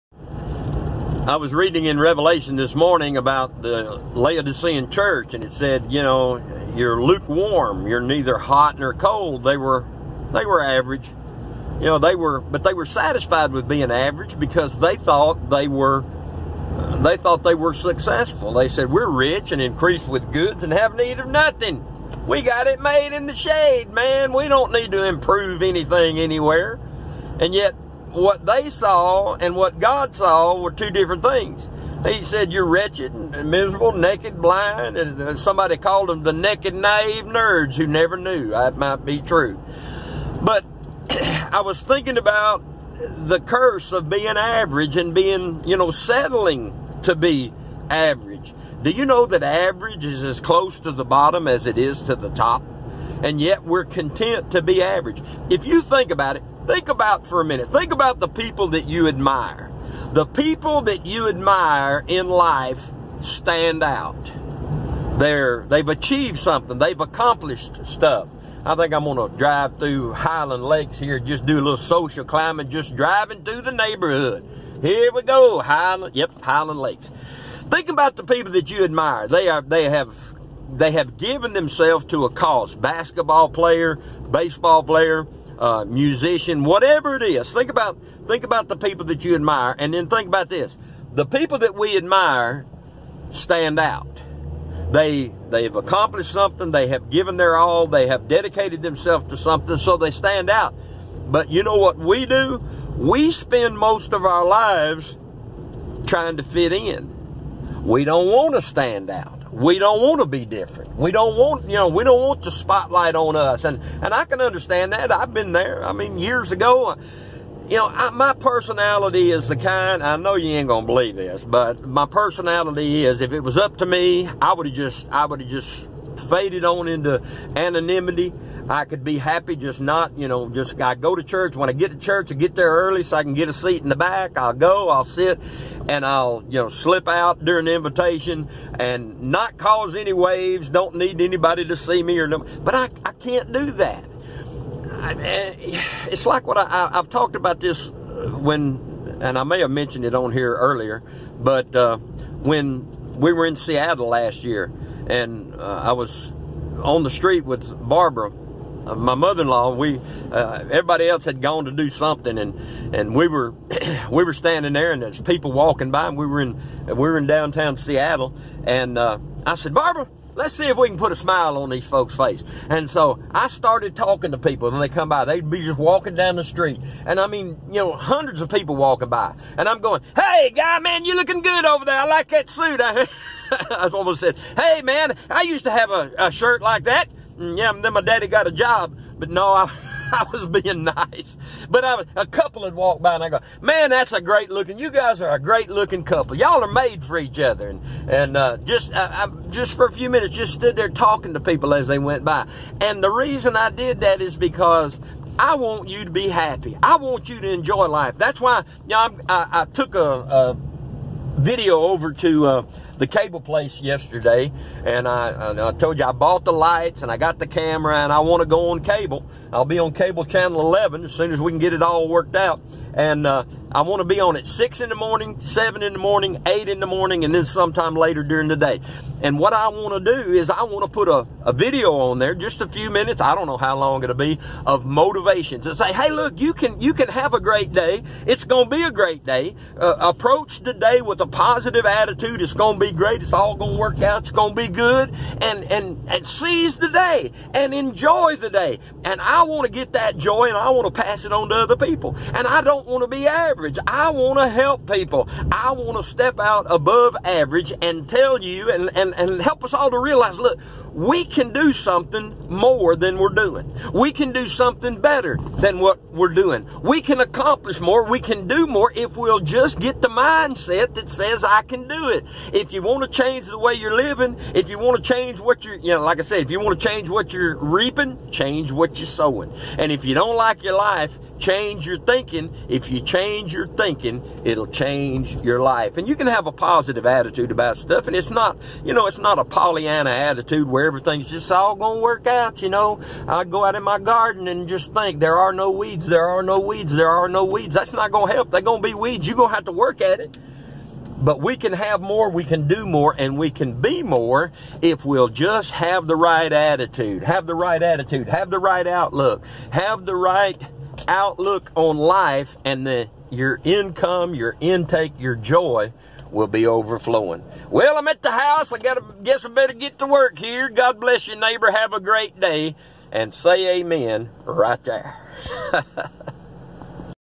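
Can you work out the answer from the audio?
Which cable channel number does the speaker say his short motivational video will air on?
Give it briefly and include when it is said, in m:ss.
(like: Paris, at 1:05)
11, at 3:40.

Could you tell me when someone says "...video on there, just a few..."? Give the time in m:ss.
3:51.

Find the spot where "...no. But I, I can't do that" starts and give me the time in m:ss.
2:22.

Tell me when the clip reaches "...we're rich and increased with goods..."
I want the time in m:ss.
0:18.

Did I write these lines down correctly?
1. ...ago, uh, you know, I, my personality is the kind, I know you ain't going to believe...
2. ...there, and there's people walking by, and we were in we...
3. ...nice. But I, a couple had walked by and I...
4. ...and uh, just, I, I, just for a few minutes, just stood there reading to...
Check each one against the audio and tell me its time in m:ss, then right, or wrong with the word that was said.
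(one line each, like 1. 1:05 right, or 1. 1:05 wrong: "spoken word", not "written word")
1. 1:56 right
2. 2:44 right
3. 3:10 right
4. 3:18 wrong: "talking", not "reading".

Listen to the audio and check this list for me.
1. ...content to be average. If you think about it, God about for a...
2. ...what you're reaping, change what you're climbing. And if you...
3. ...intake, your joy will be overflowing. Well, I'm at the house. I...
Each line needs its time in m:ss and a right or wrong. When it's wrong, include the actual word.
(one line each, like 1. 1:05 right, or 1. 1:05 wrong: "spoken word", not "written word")
1. 0:53 wrong: "Think", not "God"
2. 4:37 wrong: "sowing", not "climbing"
3. 5:14 right.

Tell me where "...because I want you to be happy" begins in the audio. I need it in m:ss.
3:24.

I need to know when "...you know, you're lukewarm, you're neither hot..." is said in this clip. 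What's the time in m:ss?
0:05.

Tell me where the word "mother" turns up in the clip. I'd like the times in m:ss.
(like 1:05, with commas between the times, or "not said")
2:39.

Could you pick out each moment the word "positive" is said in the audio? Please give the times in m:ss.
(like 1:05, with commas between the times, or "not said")
4:01, 4:46.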